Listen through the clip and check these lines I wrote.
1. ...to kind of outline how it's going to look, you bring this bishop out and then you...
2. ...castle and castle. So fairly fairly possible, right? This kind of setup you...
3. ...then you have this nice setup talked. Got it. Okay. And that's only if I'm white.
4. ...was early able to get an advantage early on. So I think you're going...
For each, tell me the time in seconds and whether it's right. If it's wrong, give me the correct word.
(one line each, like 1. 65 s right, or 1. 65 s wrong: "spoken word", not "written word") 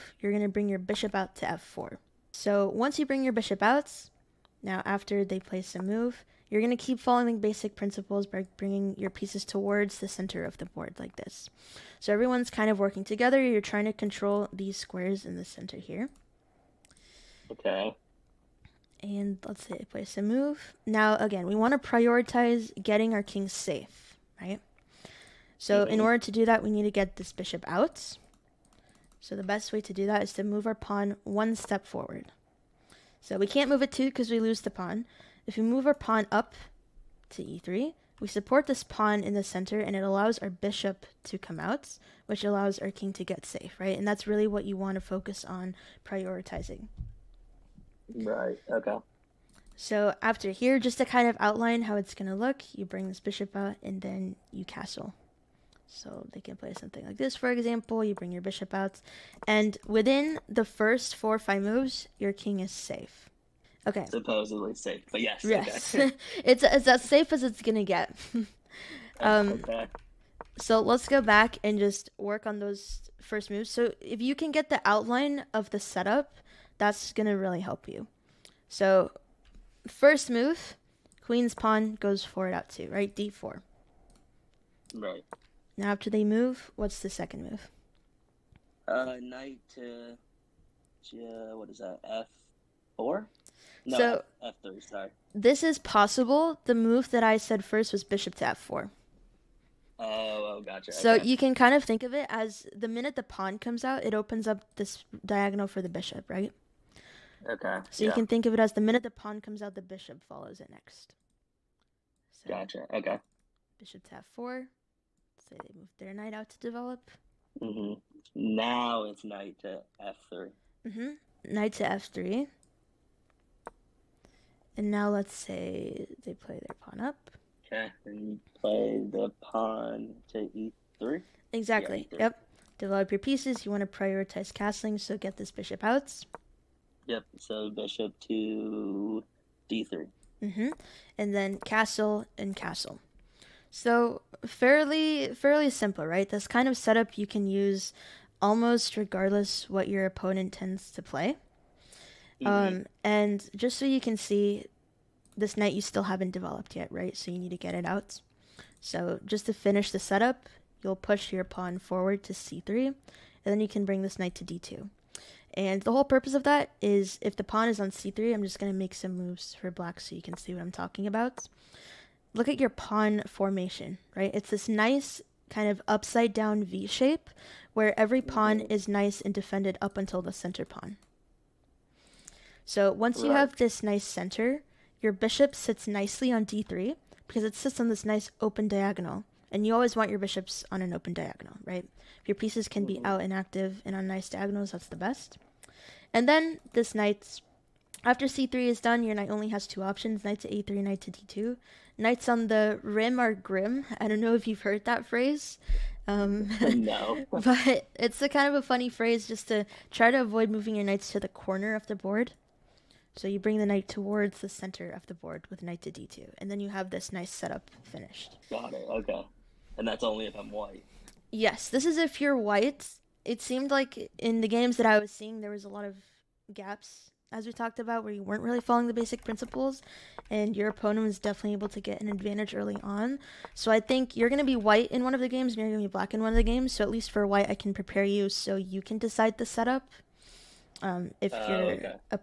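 1. 50 s right
2. 141 s wrong: "simple", not "possible"
3. 216 s wrong: "finished", not "talked"
4. 231 s wrong: "definitely", not "early".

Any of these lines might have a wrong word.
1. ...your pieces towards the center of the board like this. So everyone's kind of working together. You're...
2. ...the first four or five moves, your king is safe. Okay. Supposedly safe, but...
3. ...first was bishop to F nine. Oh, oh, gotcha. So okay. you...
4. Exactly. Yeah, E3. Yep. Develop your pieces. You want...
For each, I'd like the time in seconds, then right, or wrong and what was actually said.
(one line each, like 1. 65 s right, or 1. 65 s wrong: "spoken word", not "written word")
1. 8 s right
2. 60 s right
3. 97 s wrong: "four", not "nine"
4. 131 s right.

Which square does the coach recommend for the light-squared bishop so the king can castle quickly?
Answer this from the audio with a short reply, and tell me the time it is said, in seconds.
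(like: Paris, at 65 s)
d3, at 137 s.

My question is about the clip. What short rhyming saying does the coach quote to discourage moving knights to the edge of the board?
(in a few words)
Knights on the rim are grim.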